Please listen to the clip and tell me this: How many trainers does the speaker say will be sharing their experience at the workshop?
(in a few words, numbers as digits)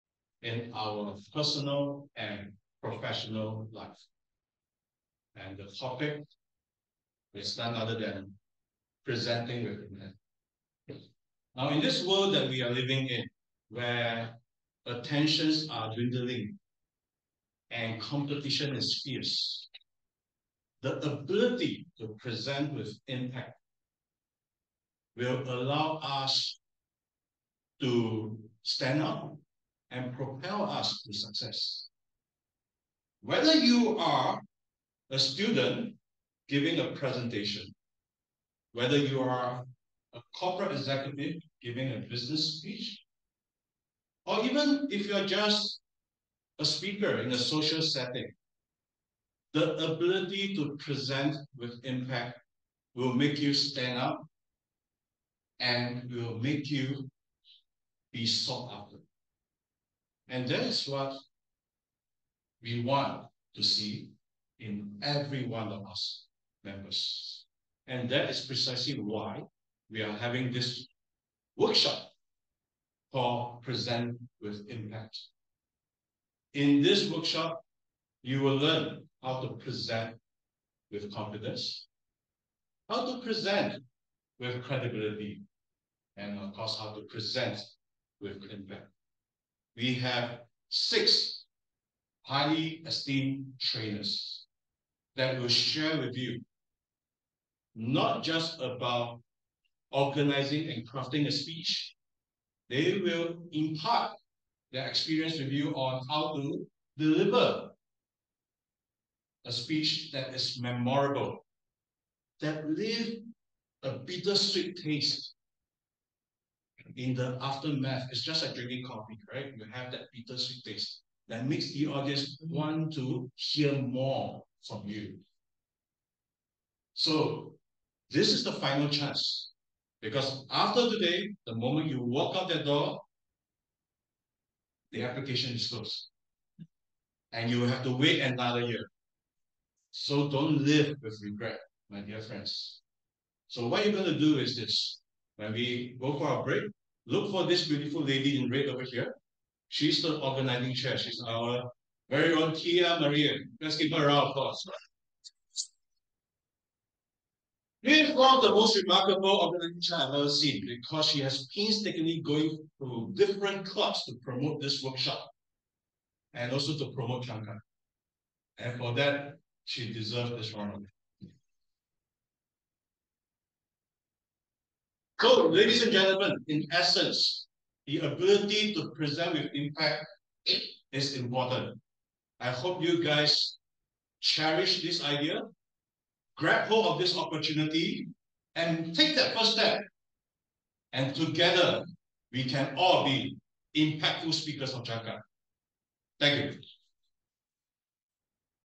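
6.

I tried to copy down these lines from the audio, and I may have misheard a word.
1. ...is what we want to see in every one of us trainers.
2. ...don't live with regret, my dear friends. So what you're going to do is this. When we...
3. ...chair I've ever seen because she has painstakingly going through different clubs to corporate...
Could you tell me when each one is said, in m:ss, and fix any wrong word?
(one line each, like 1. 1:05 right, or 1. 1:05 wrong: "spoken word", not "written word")
1. 1:00 wrong: "members", not "trainers"
2. 2:20 right
3. 2:39 wrong: "promote", not "corporate".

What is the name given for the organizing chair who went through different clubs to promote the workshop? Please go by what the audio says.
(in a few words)
Tia Maria.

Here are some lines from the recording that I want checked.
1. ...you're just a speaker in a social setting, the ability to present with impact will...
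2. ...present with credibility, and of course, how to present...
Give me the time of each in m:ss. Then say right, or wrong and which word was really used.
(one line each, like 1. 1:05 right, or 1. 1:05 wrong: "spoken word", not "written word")
1. 0:45 right
2. 1:23 right.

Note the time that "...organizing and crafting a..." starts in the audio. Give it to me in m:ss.
1:39.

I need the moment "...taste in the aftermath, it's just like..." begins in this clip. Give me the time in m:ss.
1:54.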